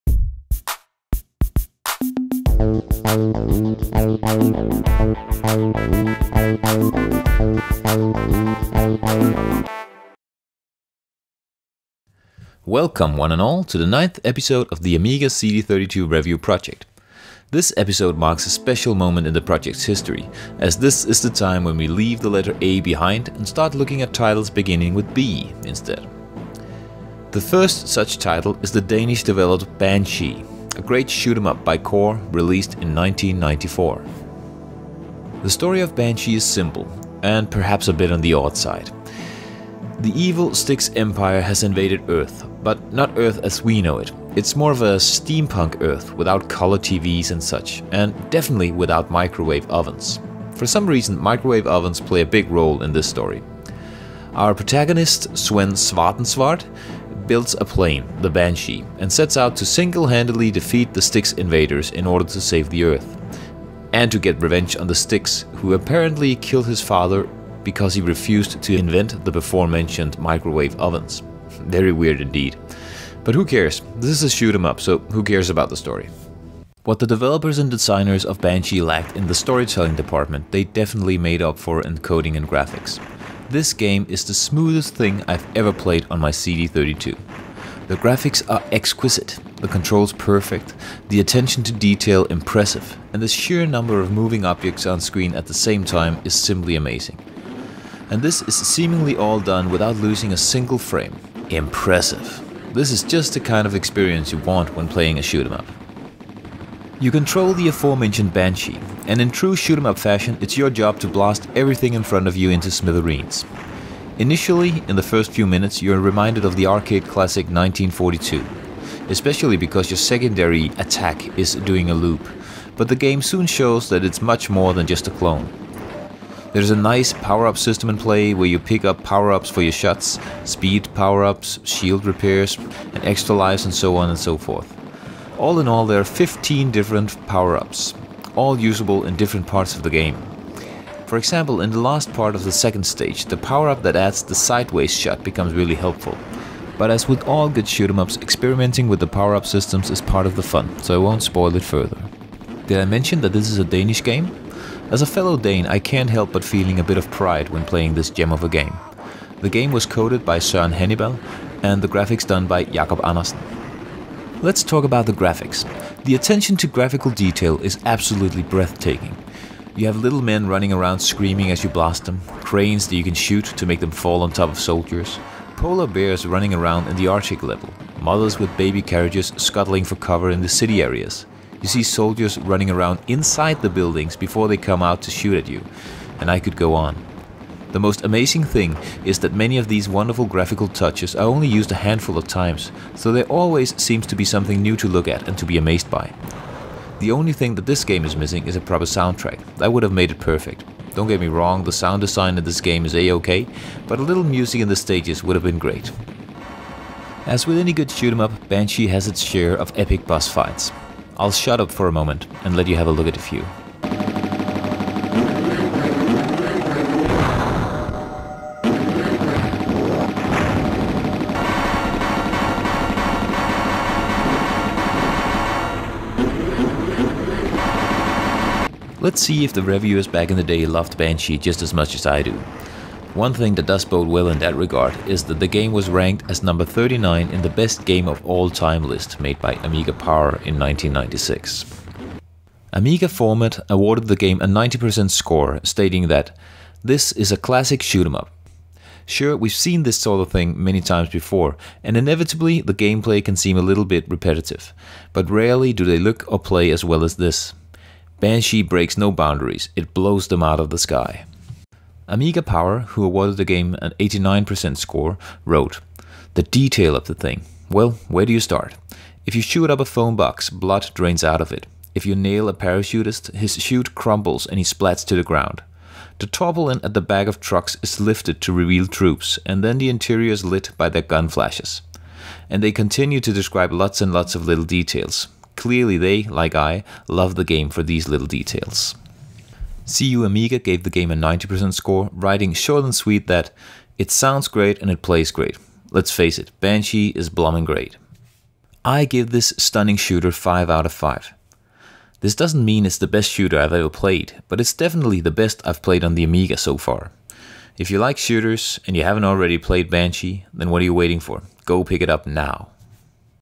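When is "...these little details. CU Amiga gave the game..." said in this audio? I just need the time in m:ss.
4:47.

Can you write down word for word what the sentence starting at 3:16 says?
The only thing that this game is missing is a proper soundtrack, that would have made it perfect.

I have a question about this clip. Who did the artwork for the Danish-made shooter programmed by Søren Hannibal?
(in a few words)
Jakob Andersen.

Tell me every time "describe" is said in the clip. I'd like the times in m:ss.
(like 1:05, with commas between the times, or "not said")
4:43.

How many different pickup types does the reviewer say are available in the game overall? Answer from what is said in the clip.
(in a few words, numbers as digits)
15.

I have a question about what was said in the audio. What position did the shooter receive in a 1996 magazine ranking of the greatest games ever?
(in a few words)
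39.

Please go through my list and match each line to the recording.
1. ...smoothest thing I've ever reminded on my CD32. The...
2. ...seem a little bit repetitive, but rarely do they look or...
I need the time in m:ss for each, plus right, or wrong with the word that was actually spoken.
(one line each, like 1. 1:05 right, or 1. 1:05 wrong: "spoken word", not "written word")
1. 1:24 wrong: "played", not "reminded"
2. 4:13 right.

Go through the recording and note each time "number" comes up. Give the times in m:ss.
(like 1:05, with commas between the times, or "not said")
1:33, 3:56.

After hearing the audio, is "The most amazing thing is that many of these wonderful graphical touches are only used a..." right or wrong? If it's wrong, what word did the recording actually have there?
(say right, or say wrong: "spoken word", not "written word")
right.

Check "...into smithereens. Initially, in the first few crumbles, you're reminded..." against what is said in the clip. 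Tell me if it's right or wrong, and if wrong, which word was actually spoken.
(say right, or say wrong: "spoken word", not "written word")
wrong: "minutes", not "crumbles".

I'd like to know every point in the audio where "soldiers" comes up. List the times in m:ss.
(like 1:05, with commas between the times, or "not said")
2:54, 3:01.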